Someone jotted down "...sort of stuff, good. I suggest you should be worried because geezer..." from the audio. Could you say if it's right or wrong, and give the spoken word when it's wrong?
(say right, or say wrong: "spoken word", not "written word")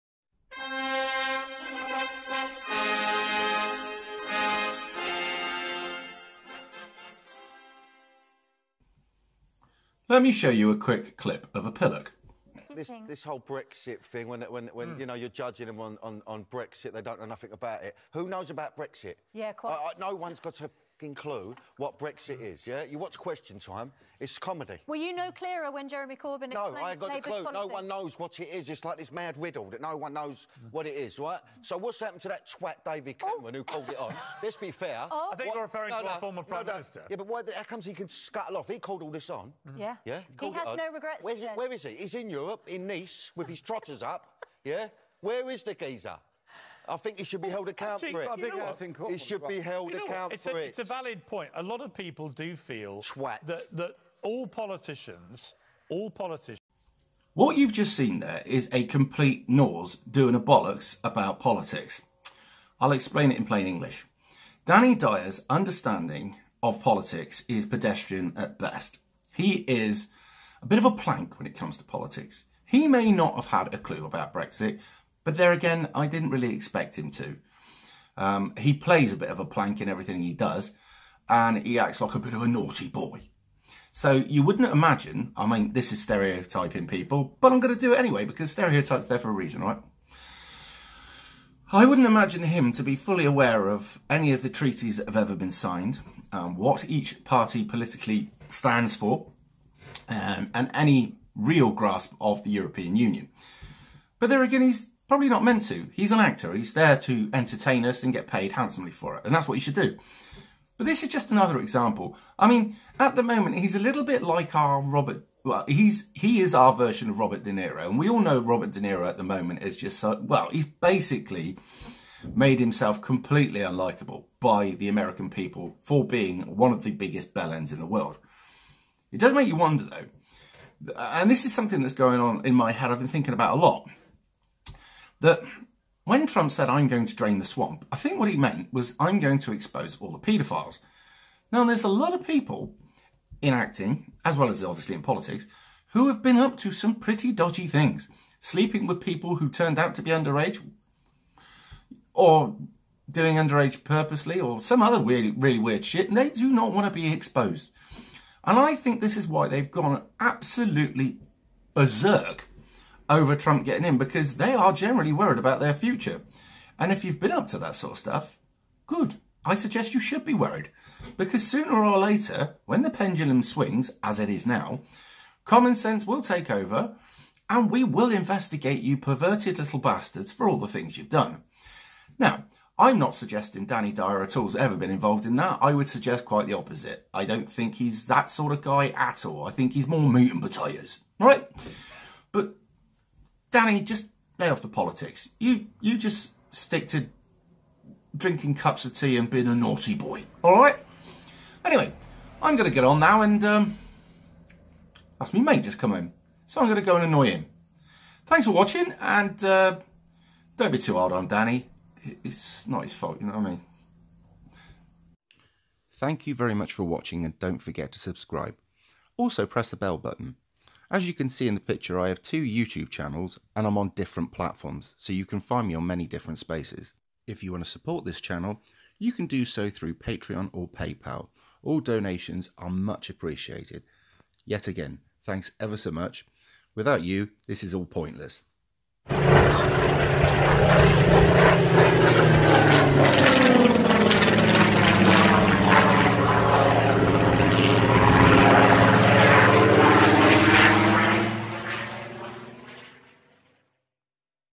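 wrong: "sooner", not "geezer".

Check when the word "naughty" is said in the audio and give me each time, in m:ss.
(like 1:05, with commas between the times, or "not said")
1:22, 3:19.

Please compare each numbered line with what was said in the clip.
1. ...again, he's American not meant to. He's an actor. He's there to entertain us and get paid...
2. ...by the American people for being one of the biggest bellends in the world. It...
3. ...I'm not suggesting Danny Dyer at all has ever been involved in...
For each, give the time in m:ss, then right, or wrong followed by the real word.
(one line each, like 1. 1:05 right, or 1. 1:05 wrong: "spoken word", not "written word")
1. 1:44 wrong: "Probably", not "American"
2. 2:04 right
3. 3:02 right.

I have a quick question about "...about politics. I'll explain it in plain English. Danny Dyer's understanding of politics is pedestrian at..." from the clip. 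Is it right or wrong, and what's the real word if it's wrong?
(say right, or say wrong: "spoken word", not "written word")
right.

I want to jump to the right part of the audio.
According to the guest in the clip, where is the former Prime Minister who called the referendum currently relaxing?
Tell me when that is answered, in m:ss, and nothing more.
0:42.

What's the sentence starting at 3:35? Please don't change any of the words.
Thank you very much for watching and don't forget to subscribe.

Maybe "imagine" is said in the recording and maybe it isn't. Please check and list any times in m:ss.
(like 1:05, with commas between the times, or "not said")
1:24, 1:32.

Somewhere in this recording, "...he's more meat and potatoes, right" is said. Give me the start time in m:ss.
3:09.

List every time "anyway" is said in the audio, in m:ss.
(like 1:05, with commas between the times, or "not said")
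1:27, 3:21.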